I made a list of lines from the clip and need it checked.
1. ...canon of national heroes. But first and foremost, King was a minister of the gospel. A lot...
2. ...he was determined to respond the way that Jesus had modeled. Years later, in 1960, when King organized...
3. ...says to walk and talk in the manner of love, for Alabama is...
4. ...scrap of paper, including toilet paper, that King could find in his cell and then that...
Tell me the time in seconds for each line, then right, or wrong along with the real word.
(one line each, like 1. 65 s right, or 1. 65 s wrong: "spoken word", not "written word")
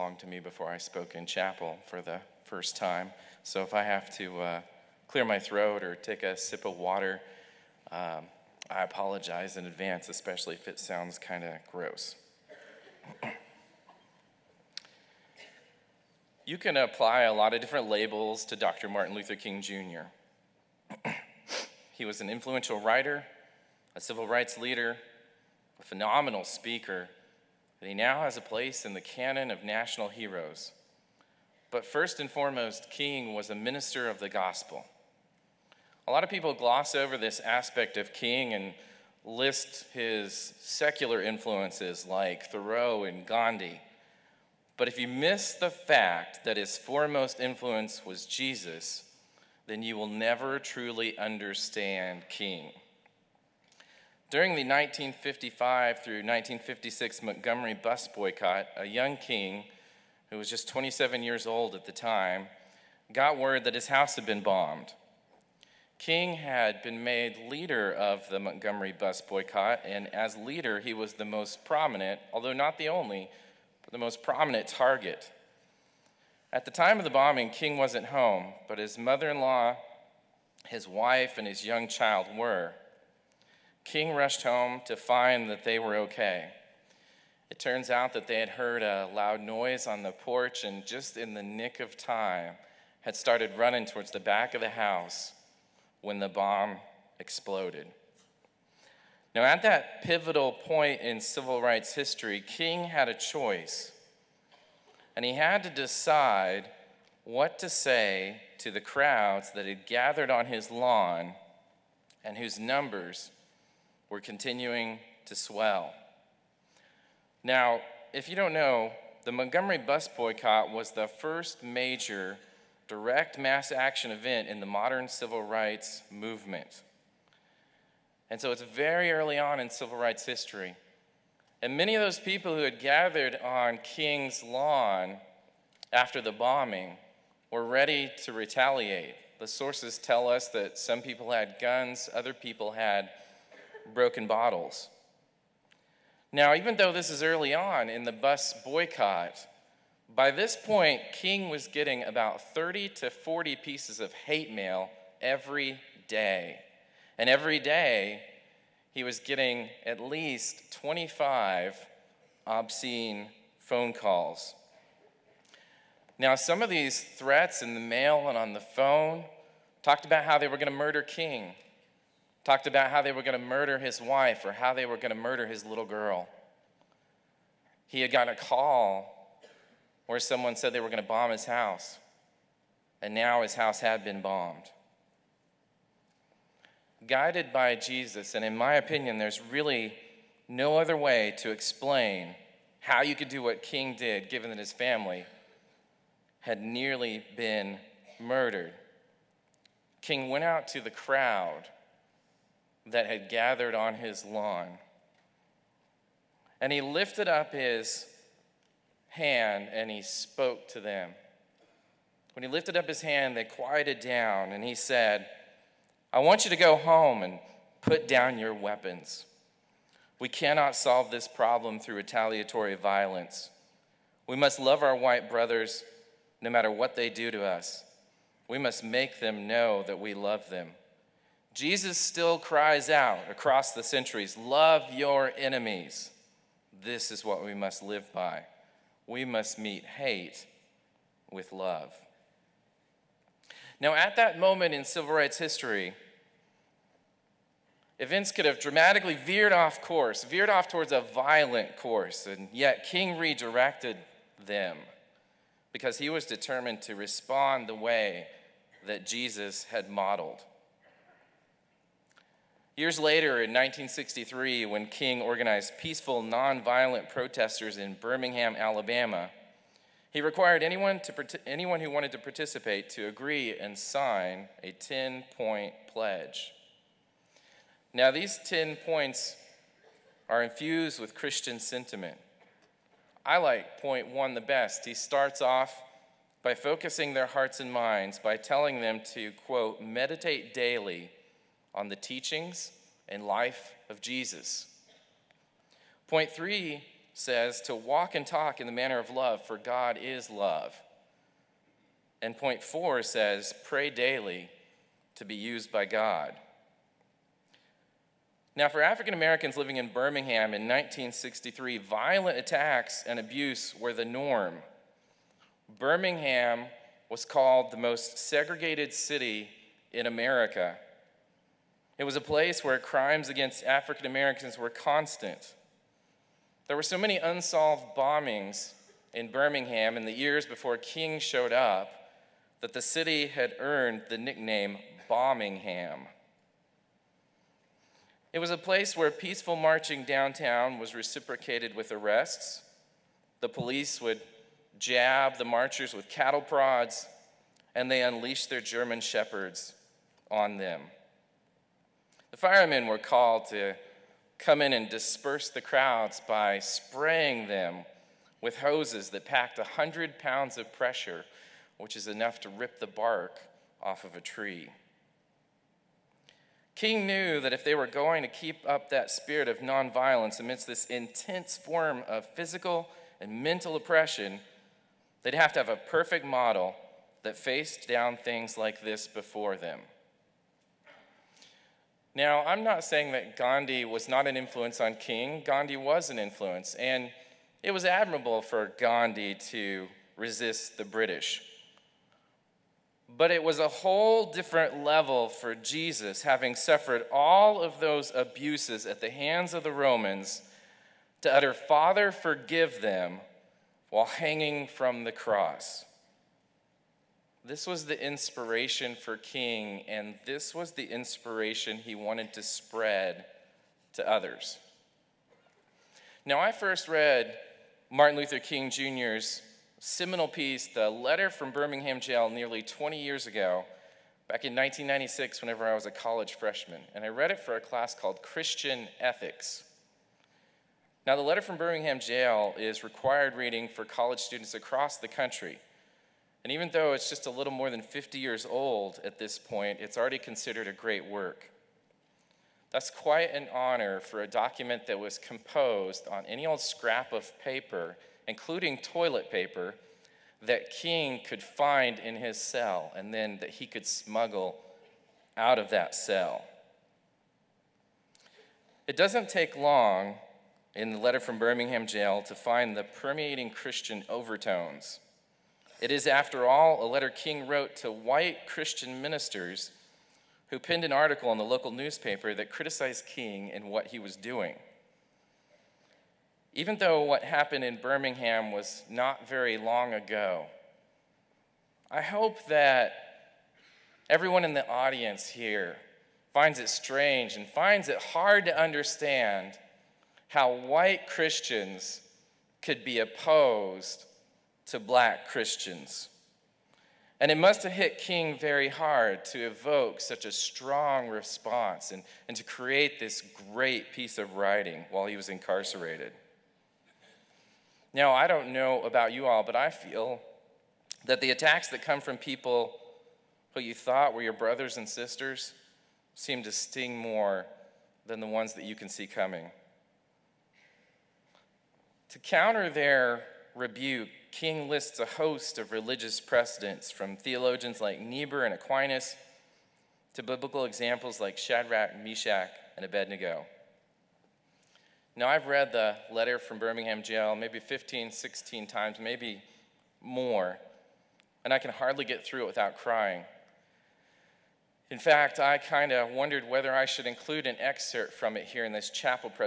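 1. 29 s right
2. 255 s wrong: "1963", not "1960"
3. 297 s wrong: "God", not "Alabama"
4. 446 s right.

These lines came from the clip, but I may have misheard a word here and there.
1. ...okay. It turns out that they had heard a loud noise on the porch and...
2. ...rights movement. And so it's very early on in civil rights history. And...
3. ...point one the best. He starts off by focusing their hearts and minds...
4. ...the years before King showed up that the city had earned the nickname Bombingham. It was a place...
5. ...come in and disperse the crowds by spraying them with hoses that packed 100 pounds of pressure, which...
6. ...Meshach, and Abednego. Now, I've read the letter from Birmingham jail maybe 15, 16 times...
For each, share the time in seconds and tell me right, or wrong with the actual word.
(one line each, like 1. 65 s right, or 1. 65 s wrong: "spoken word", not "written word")
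1. 85 s right
2. 125 s right
3. 283 s right
4. 330 s right
5. 354 s right
6. 532 s right.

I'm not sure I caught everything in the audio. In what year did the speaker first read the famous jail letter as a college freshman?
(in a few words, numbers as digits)
1996.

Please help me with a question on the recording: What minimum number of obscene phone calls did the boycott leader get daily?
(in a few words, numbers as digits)
25.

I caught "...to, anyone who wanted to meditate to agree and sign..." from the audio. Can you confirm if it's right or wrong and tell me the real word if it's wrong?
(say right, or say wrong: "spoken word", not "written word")
wrong: "participate", not "meditate".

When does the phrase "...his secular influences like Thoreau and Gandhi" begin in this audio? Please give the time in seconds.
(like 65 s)
39 s.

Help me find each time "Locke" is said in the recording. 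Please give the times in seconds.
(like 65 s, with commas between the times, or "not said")
not said.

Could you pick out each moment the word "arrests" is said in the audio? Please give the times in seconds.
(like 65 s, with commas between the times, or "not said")
341 s.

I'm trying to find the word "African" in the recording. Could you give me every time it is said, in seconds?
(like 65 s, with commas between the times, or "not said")
308 s, 323 s.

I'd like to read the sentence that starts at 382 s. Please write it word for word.
Now, I'm not saying that Gandhi was not an influence on King.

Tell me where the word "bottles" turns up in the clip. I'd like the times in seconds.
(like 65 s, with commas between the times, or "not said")
144 s.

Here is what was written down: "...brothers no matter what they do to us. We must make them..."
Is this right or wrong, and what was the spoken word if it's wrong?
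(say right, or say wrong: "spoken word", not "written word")
right.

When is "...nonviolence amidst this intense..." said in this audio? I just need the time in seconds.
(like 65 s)
369 s.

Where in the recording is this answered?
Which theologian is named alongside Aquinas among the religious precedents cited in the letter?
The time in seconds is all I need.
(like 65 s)
527 s.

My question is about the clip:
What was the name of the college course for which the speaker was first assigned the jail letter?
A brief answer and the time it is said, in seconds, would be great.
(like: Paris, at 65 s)
Christian Ethics, at 428 s.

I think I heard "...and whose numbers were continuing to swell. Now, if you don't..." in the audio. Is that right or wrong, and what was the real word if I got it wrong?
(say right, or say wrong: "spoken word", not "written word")
right.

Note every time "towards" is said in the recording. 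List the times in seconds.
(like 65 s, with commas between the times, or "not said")
93 s, 250 s.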